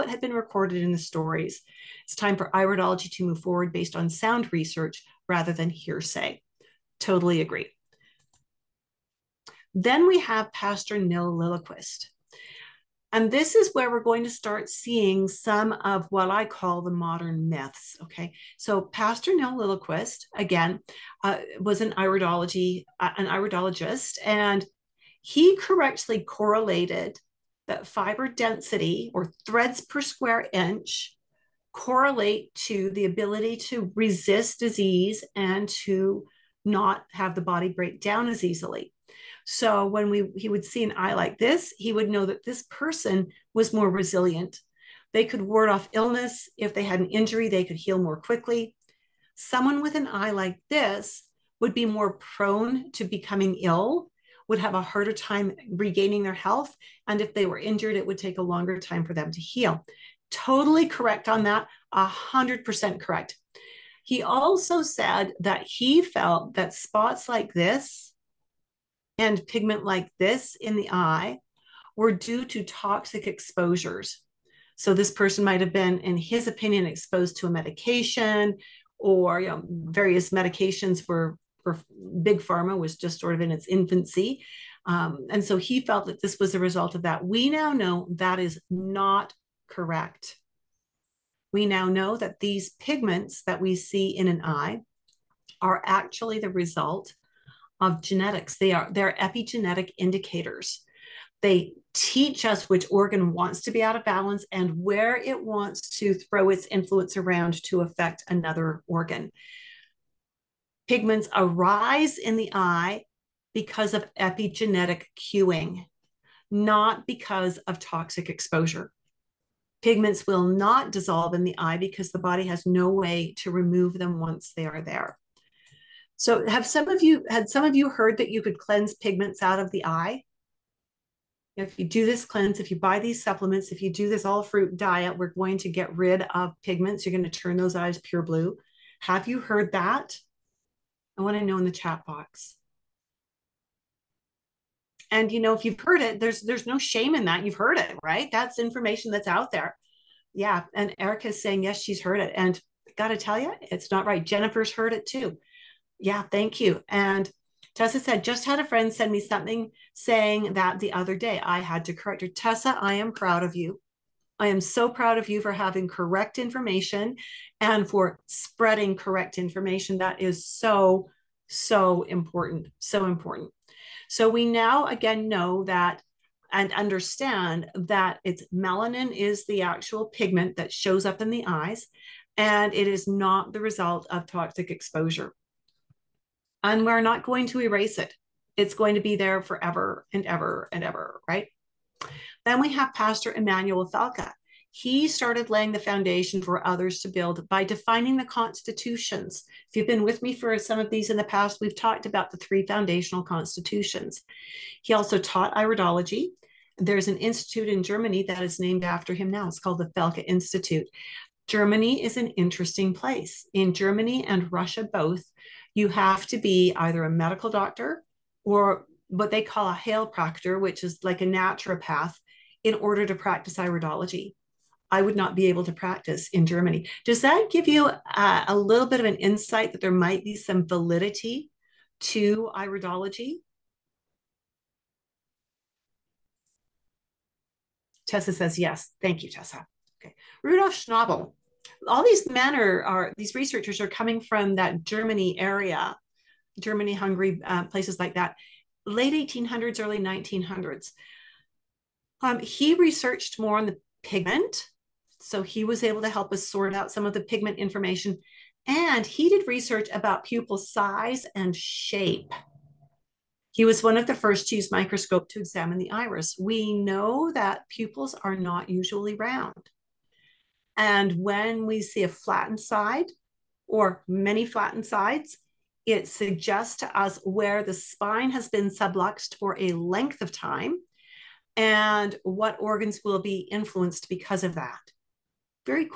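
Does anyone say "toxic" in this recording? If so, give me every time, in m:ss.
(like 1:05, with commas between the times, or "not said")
1:12, 1:57, 3:04.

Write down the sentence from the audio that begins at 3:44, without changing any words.
I would not be able to practice in Germany.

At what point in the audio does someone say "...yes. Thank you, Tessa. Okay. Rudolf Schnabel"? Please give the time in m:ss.
3:58.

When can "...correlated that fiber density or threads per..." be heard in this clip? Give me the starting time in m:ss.
0:26.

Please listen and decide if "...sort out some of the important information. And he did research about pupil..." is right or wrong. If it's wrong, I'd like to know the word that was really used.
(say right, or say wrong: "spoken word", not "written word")
wrong: "pigment", not "important".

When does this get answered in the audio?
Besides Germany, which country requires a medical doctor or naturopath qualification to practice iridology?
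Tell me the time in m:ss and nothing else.
3:34.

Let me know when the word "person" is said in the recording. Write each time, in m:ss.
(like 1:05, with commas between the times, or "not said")
0:42, 1:15.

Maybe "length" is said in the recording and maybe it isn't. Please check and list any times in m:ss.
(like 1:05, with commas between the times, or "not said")
4:39.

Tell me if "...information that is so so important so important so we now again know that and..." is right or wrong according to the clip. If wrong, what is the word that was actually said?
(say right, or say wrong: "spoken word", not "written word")
right.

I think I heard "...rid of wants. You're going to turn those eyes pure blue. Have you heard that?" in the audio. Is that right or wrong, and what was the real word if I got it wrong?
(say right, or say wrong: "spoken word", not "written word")
wrong: "pigments", not "wants".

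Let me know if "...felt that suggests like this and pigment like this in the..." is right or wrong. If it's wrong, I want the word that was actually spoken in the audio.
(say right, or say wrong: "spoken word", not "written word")
wrong: "spots", not "suggests".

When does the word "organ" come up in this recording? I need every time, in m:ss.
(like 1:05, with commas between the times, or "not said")
1:42, 1:48, 4:42.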